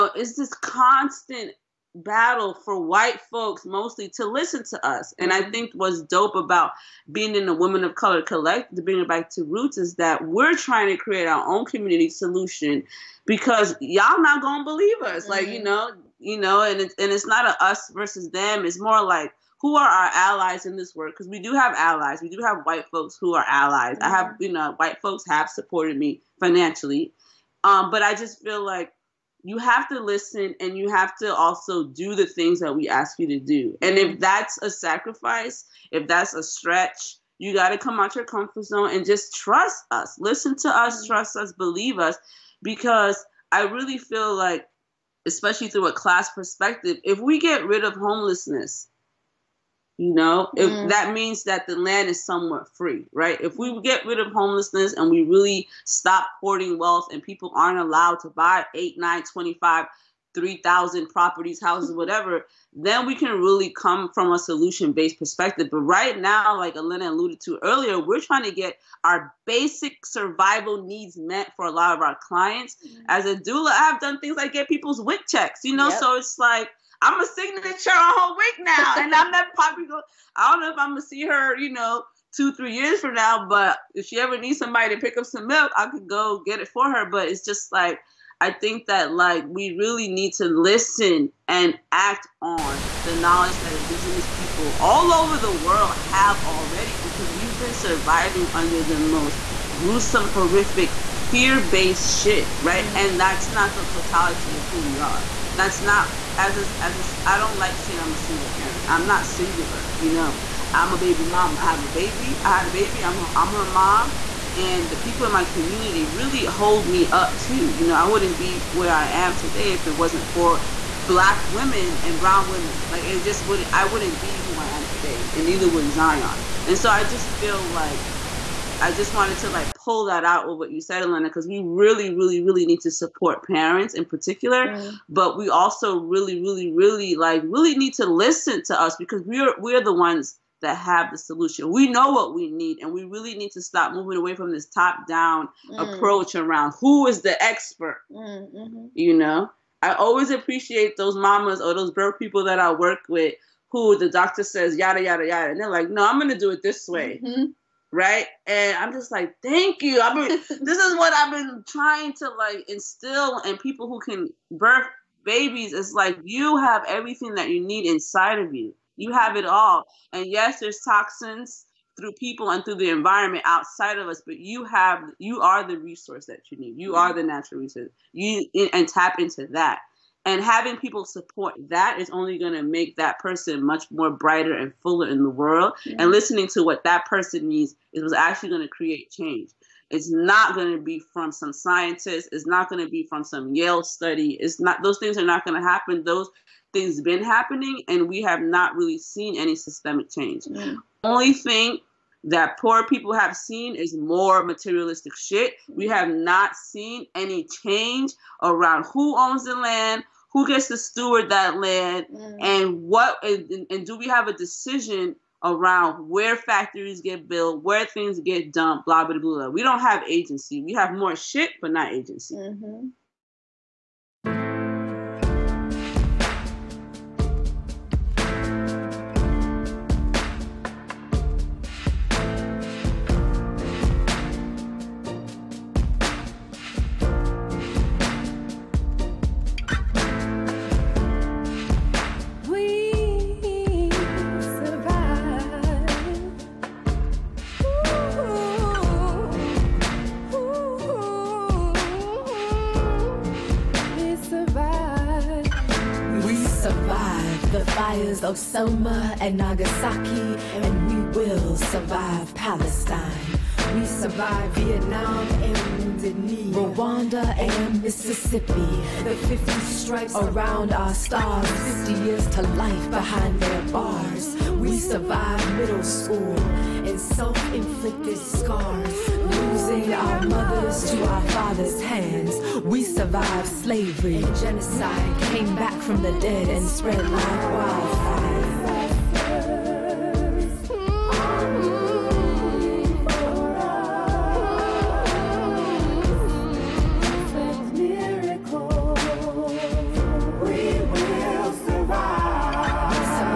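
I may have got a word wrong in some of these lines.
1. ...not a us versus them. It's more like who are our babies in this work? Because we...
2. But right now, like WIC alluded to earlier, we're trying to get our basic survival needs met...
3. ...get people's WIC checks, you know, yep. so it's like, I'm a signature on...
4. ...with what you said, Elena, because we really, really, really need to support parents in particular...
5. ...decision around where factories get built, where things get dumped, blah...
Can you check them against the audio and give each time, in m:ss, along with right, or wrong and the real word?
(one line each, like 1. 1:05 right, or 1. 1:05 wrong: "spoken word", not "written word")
1. 0:17 wrong: "allies", not "babies"
2. 1:05 wrong: "Elena", not "WIC"
3. 1:14 right
4. 2:10 right
5. 3:34 right.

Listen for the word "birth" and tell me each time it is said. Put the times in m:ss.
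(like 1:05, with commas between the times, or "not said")
2:31, 2:44.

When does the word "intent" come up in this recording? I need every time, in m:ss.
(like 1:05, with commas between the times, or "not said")
not said.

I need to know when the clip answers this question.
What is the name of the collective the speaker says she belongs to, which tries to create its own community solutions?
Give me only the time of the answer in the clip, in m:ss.
0:07.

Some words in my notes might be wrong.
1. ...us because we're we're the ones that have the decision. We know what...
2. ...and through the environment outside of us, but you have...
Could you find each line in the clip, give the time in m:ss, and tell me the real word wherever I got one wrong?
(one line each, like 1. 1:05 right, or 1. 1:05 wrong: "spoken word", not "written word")
1. 2:18 wrong: "solution", not "decision"
2. 2:52 right.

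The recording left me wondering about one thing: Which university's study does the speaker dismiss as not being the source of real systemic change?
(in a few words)
Yale.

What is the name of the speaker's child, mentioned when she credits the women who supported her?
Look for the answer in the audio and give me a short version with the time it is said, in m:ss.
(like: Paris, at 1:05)
Zion, at 2:05.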